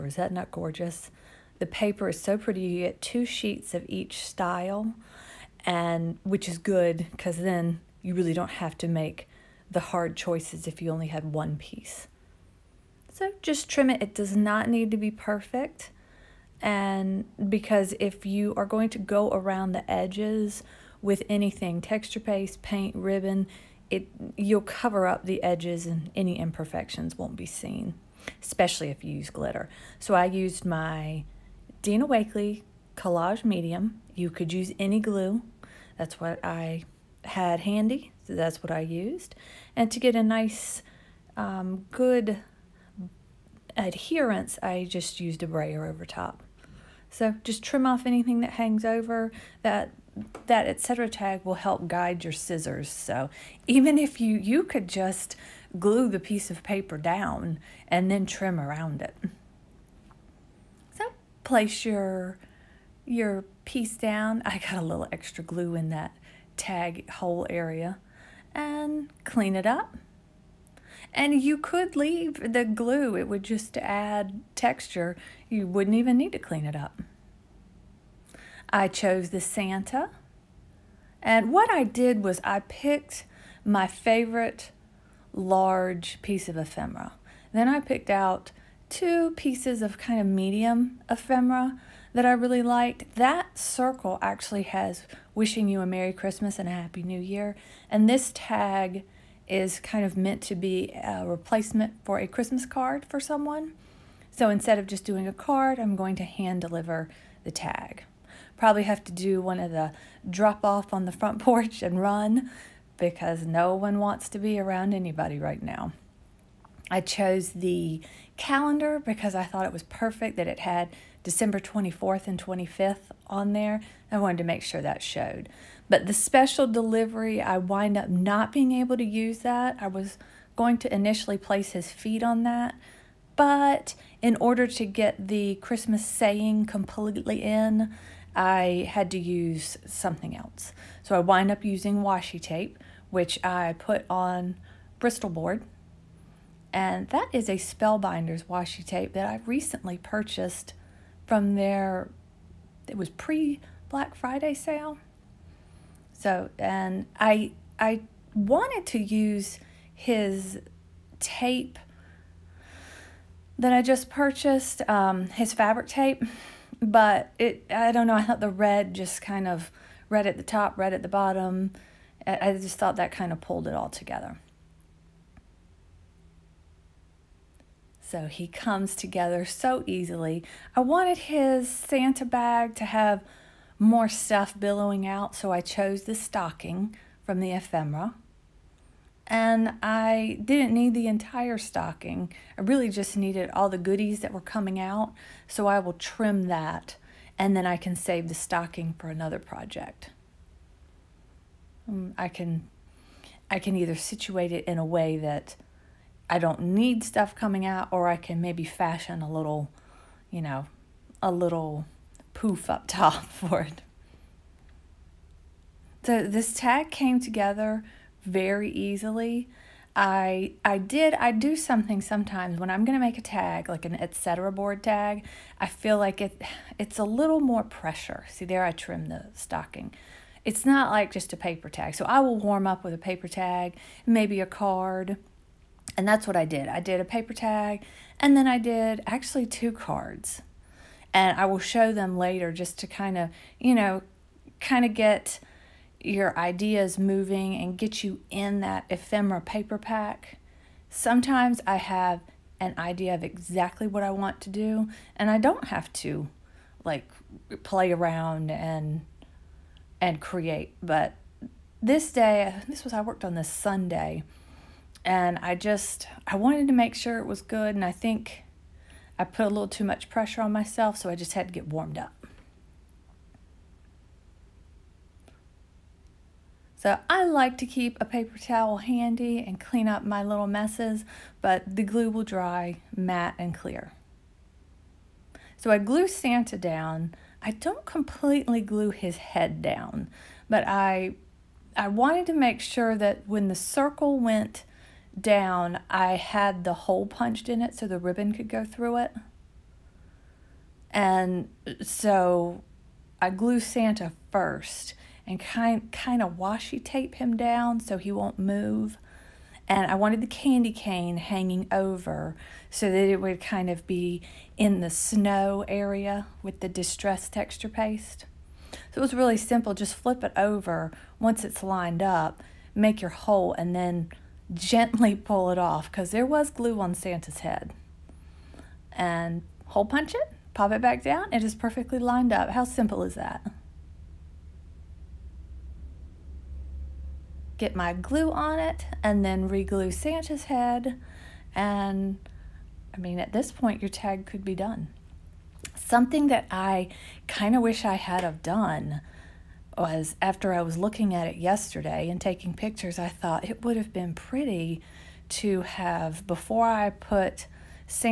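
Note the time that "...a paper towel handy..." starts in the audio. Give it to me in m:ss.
4:37.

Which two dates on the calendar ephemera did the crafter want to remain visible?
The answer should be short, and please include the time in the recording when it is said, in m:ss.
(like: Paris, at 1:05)
December 24th and 25th, at 2:01.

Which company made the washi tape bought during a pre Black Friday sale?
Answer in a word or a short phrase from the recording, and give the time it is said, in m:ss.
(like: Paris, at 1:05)
Spellbinders, at 2:27.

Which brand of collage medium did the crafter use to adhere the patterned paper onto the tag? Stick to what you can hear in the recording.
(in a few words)
Dina Wakley.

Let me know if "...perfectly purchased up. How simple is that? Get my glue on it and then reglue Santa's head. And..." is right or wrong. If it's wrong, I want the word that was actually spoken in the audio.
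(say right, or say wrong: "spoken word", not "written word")
wrong: "lined", not "purchased".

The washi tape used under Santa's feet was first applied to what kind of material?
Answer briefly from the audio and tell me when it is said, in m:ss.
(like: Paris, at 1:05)
Bristol board, at 2:24.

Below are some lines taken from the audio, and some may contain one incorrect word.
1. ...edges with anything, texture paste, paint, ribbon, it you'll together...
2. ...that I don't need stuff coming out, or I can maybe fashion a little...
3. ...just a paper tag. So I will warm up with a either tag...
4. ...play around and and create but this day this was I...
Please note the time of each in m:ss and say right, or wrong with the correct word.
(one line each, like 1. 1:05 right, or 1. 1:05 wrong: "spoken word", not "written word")
1. 0:19 wrong: "cover", not "together"
2. 3:25 right
3. 3:51 wrong: "paper", not "either"
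4. 4:17 right.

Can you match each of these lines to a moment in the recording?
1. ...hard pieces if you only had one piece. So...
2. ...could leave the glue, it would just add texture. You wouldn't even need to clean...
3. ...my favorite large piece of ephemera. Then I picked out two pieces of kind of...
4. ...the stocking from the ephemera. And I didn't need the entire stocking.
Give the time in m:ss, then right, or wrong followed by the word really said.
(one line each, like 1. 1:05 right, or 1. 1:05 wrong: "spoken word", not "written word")
1. 0:09 wrong: "choices", not "pieces"
2. 1:11 right
3. 1:23 right
4. 3:06 right.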